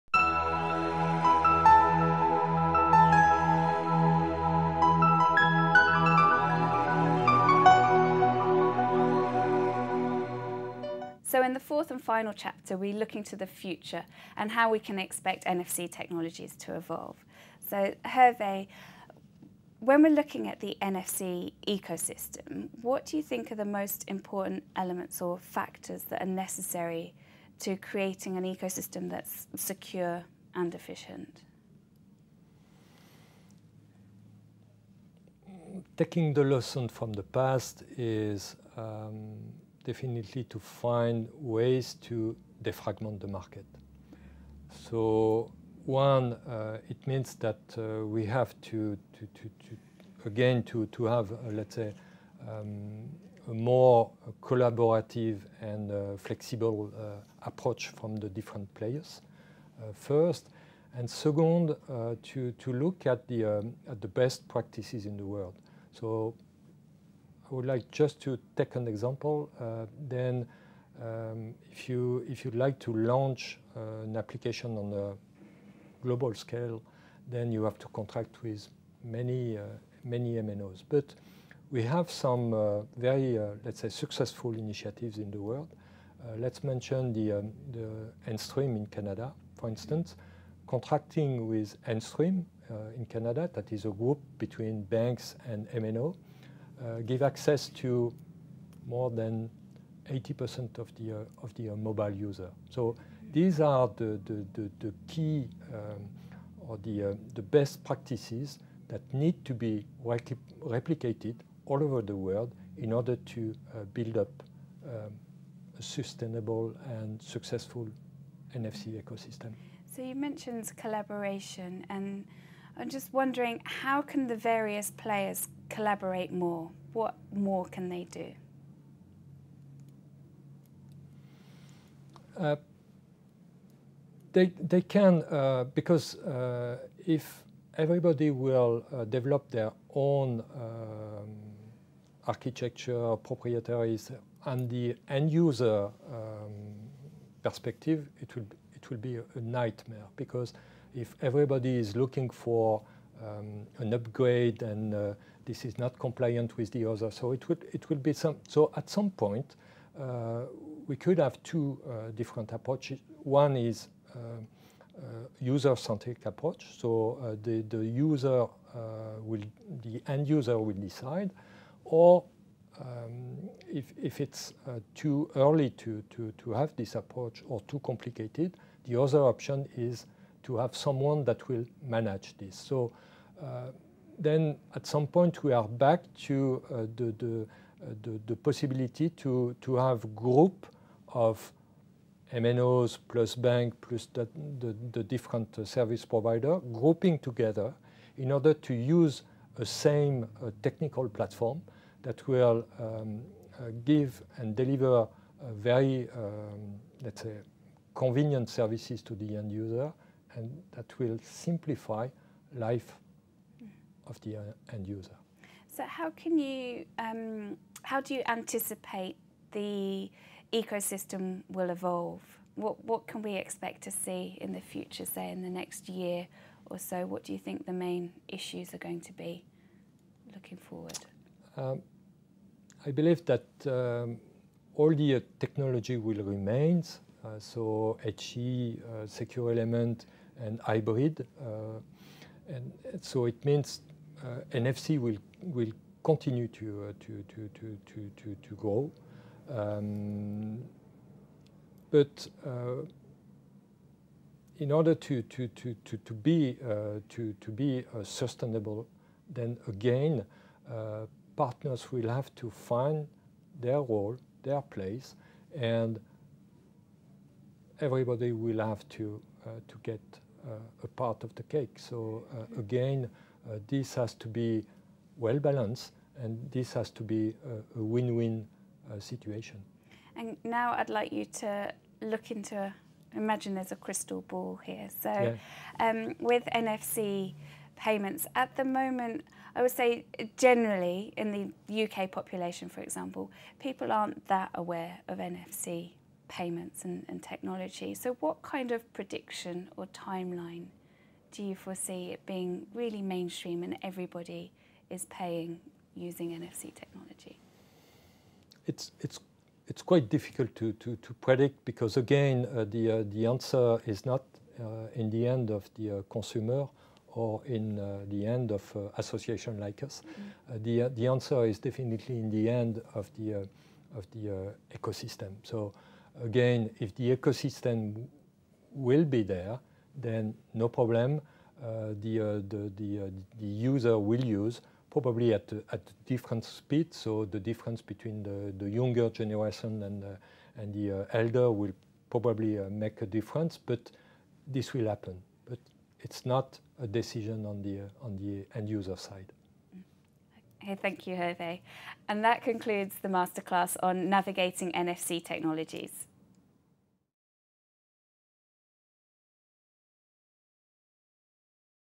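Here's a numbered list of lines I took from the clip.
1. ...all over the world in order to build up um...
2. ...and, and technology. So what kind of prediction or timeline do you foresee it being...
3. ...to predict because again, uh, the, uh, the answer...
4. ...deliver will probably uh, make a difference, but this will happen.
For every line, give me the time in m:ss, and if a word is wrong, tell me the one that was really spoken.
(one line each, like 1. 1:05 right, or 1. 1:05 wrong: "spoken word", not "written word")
1. 1:51 right
2. 4:56 right
3. 5:11 right
4. 5:41 wrong: "elder", not "deliver".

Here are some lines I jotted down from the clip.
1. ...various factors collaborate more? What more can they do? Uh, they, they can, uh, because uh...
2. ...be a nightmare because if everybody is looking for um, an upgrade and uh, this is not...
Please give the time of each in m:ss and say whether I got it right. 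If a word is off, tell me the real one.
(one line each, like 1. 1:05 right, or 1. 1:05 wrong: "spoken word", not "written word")
1. 2:04 wrong: "players", not "factors"
2. 2:28 right.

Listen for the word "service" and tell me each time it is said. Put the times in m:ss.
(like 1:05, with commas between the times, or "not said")
3:15, 3:28.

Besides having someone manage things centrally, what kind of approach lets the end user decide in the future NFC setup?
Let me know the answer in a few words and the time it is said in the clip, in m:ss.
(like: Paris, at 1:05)
user-centric approach, at 2:45.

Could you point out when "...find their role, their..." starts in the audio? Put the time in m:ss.
4:22.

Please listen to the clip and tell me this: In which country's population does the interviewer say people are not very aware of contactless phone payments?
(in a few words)
UK.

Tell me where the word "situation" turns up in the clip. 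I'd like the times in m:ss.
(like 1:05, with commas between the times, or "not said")
4:38.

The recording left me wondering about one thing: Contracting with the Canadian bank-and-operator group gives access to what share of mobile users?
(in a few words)
more than 80%.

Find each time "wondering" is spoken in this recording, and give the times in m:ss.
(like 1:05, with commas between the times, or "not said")
2:03.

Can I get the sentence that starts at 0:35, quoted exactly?
Taking the lesson from the past is um, definitely to find ways to defragment the market.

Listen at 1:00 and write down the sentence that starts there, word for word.
And second, to, to look at the, um, at the best practices in the world.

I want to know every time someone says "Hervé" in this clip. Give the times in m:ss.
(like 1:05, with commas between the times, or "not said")
0:18, 5:51.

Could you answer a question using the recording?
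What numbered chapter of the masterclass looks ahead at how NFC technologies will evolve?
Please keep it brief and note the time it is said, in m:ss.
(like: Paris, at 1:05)
fourth, at 0:11.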